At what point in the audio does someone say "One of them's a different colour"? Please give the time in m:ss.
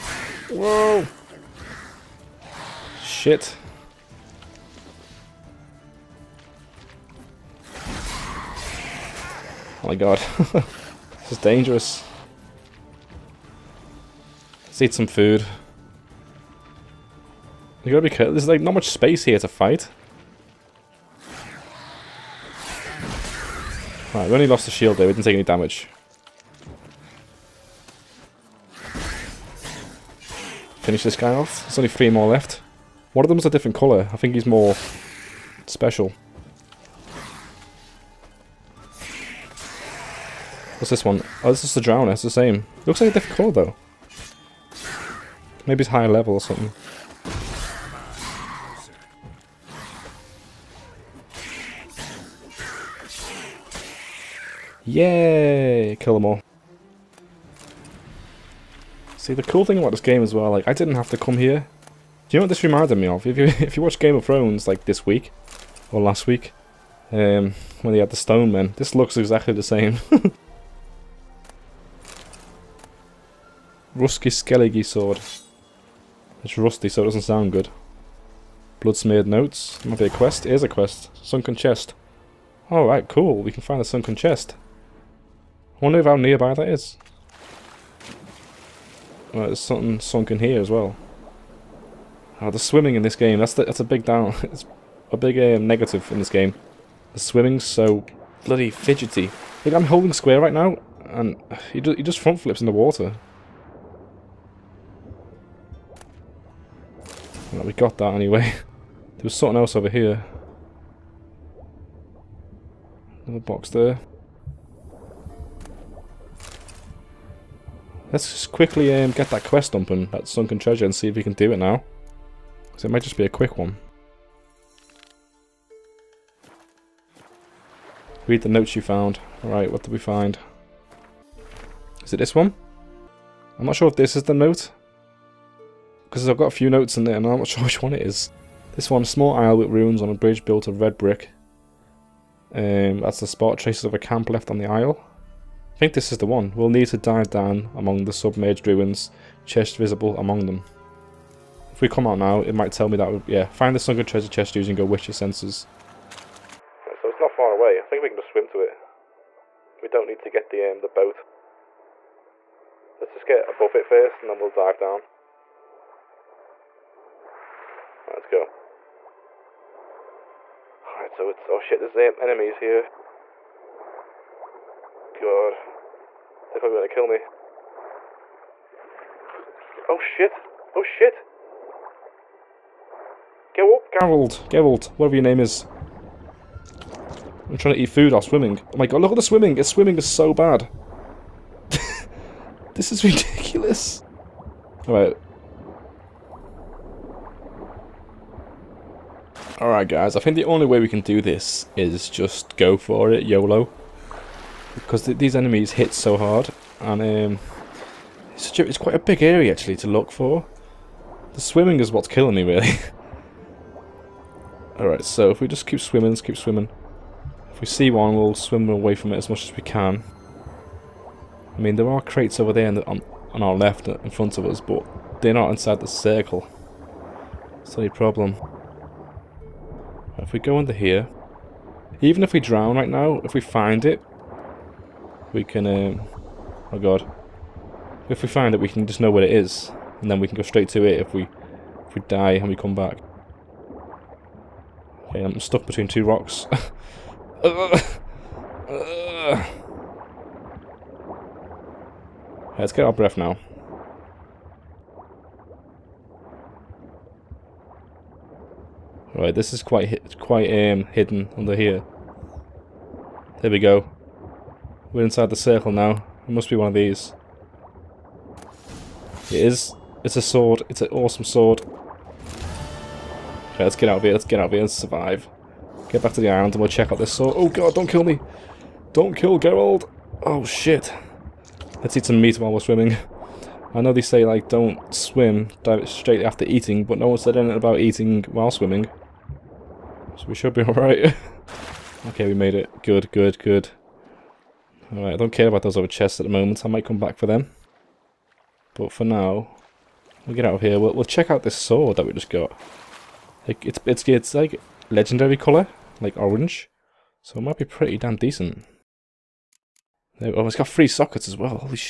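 0:33.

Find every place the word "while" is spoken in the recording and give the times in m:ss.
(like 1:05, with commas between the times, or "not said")
3:08, 4:42, 4:48.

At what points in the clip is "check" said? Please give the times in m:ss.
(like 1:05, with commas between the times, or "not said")
4:36, 5:01.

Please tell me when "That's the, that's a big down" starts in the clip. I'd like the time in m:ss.
1:33.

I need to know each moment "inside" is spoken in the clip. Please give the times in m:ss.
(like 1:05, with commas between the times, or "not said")
3:45, 4:25.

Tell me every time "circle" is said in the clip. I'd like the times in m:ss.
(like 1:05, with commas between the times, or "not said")
3:45, 4:25.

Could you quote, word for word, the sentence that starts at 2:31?
If we come out now, it might tell me that, yeah, find the sunken treasure chest using your witcher senses.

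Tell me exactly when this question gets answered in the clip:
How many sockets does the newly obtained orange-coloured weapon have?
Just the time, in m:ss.
5:10.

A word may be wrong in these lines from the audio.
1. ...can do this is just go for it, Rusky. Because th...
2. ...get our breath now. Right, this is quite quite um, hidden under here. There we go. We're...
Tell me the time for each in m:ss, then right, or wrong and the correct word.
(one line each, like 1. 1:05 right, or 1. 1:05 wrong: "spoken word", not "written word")
1. 3:20 wrong: "YOLO", not "Rusky"
2. 4:12 right.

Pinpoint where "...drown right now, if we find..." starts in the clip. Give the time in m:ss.
3:52.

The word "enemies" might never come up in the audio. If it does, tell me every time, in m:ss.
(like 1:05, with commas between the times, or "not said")
2:51, 3:25.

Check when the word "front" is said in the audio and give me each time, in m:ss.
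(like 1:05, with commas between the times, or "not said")
1:42, 3:44.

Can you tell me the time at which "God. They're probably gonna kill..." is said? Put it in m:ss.
2:55.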